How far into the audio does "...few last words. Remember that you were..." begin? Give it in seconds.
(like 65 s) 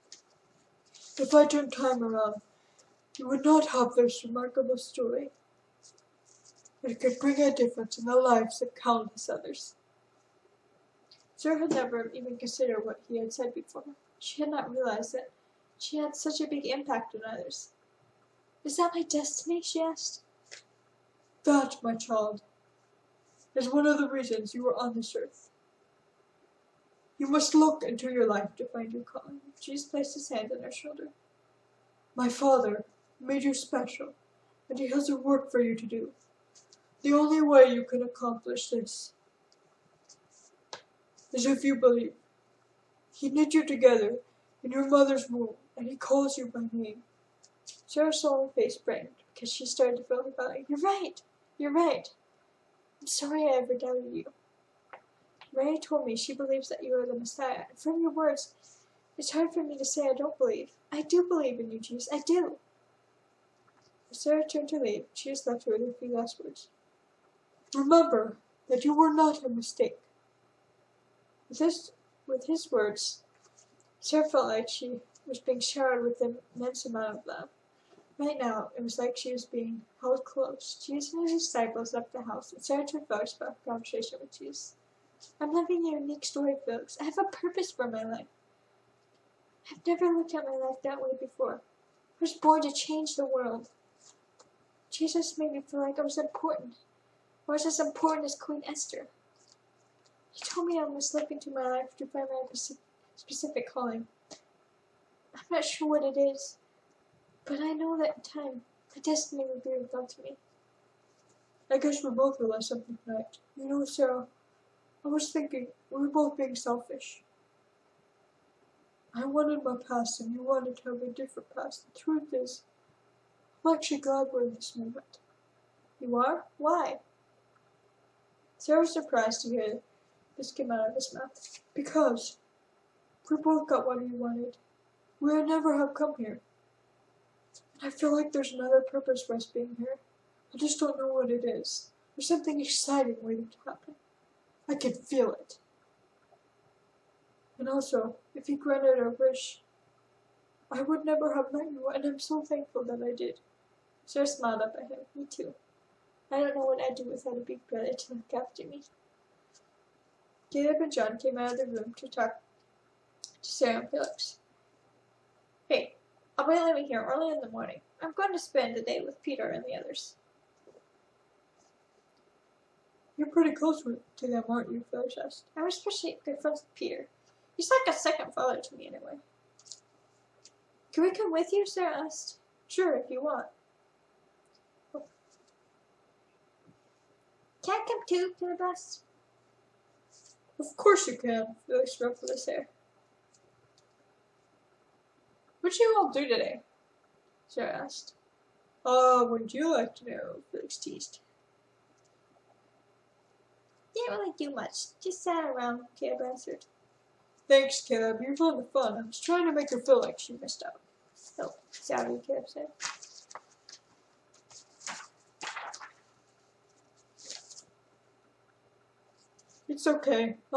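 65 s.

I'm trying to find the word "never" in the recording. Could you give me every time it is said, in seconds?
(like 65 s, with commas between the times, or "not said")
11 s, 89 s, 135 s, 151 s.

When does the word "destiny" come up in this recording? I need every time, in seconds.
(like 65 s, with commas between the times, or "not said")
19 s, 109 s.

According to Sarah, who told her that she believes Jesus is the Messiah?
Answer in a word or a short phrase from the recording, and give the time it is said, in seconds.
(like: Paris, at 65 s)
Ray, at 55 s.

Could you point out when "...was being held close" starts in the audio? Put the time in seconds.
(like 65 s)
79 s.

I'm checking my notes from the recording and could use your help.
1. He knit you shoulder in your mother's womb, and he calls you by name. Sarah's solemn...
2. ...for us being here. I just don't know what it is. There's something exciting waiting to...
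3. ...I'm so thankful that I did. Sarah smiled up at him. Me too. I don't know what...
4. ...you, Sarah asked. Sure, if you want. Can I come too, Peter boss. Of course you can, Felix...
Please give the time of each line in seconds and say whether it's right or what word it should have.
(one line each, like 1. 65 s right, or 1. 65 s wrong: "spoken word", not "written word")
1. 43 s wrong: "together", not "shoulder"
2. 139 s right
3. 152 s right
4. 181 s right.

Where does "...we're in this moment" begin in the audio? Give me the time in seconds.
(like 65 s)
124 s.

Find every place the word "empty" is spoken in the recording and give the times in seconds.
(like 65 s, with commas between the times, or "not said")
not said.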